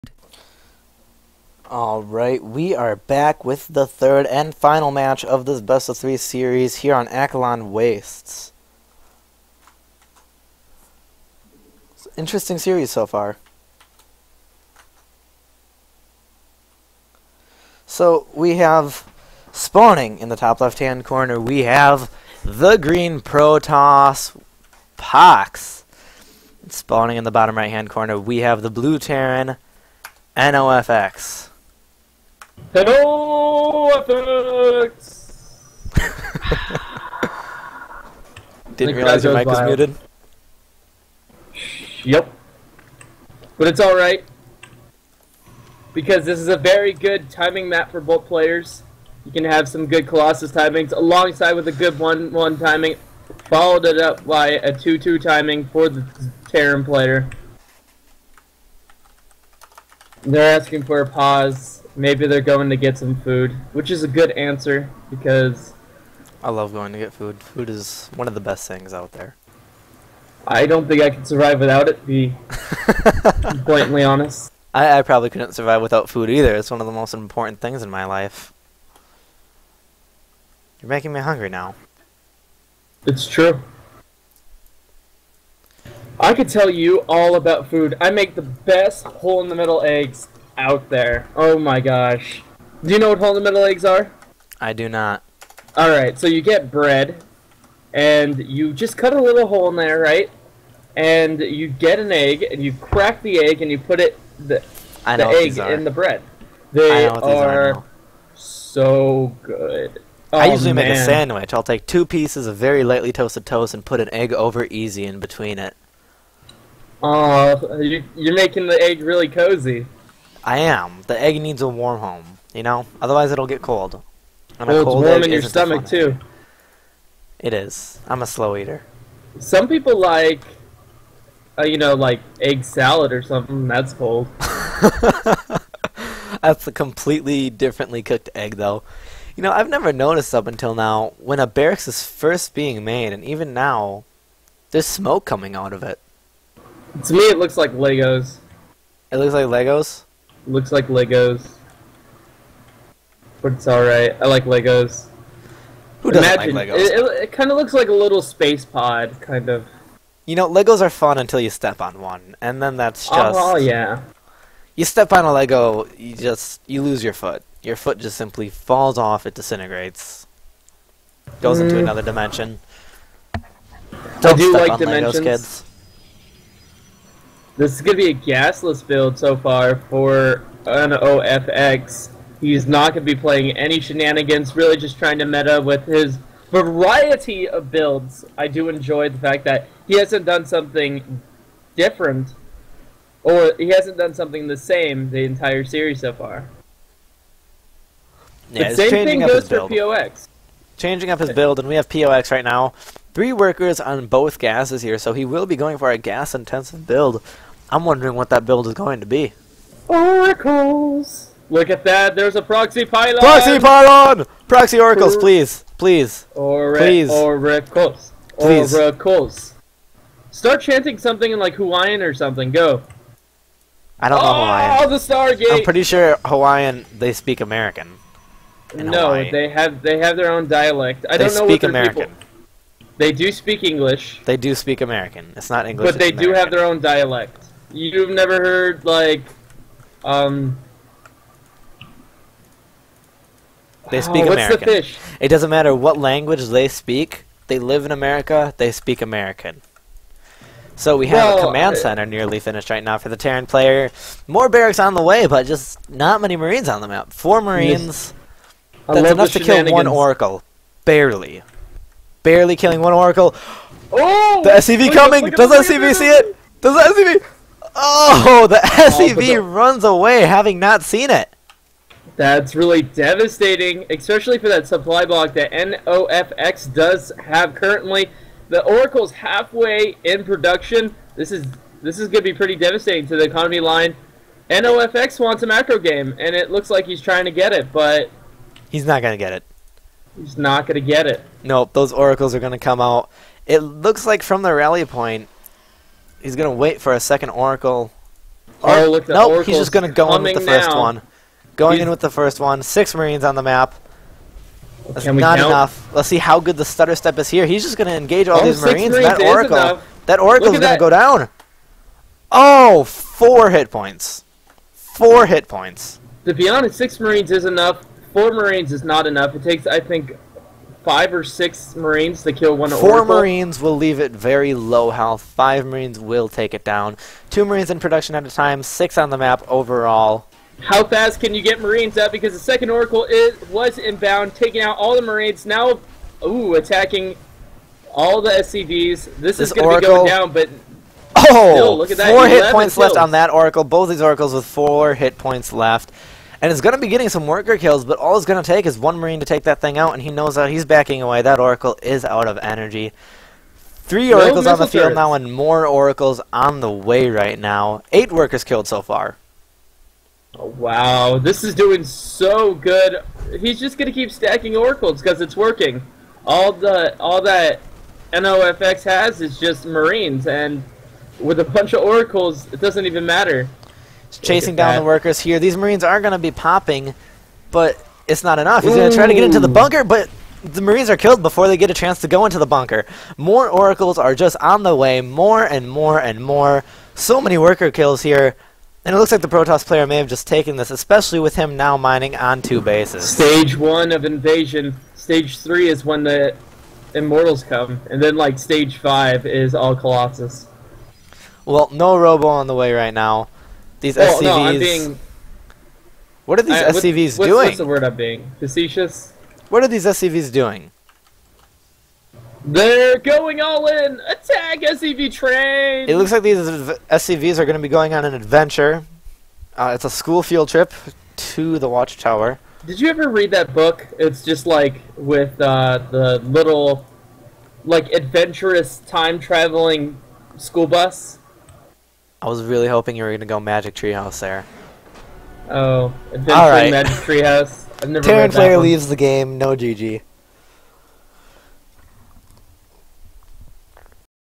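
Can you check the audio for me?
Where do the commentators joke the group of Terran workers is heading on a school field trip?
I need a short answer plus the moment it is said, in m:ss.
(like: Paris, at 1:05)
The Watchtower, at 7:01.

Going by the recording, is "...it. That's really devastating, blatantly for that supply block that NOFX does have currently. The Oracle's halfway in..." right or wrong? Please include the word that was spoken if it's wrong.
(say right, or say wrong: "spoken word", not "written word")
wrong: "especially", not "blatantly".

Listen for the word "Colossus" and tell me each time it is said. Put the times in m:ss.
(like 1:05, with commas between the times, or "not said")
0:50, 6:39.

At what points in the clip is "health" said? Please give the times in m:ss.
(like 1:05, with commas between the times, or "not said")
5:24.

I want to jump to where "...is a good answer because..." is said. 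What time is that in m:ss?
1:03.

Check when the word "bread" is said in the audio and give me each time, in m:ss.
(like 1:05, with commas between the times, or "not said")
1:36, 1:45.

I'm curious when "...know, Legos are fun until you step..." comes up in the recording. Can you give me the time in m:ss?
2:40.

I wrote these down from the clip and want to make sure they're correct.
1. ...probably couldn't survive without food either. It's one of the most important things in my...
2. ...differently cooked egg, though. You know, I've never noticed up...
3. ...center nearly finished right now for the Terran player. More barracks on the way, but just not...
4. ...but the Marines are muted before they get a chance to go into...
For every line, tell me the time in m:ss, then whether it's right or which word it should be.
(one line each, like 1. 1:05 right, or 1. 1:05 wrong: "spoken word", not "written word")
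1. 1:15 right
2. 2:17 right
3. 4:11 right
4. 6:19 wrong: "killed", not "muted".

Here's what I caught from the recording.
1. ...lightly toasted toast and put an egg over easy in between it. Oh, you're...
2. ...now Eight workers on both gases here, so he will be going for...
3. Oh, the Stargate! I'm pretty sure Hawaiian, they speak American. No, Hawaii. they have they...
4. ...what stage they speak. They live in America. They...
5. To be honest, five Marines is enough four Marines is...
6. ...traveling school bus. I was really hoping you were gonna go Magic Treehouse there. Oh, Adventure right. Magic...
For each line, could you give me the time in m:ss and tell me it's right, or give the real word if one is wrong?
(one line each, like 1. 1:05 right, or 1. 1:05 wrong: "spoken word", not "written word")
1. 1:52 right
2. 3:22 wrong: "Three", not "Eight"
3. 3:44 right
4. 4:05 wrong: "language", not "stage"
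5. 5:16 wrong: "six", not "five"
6. 7:09 right.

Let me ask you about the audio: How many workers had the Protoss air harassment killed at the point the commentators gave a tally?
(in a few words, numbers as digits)
8.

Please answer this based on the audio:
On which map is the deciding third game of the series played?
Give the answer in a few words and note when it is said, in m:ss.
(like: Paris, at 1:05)
Akilon Wastes, at 0:07.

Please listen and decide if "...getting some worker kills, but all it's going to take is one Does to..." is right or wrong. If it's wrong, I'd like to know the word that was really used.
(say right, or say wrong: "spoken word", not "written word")
wrong: "Marine", not "Does".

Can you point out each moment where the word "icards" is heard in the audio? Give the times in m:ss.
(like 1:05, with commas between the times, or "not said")
not said.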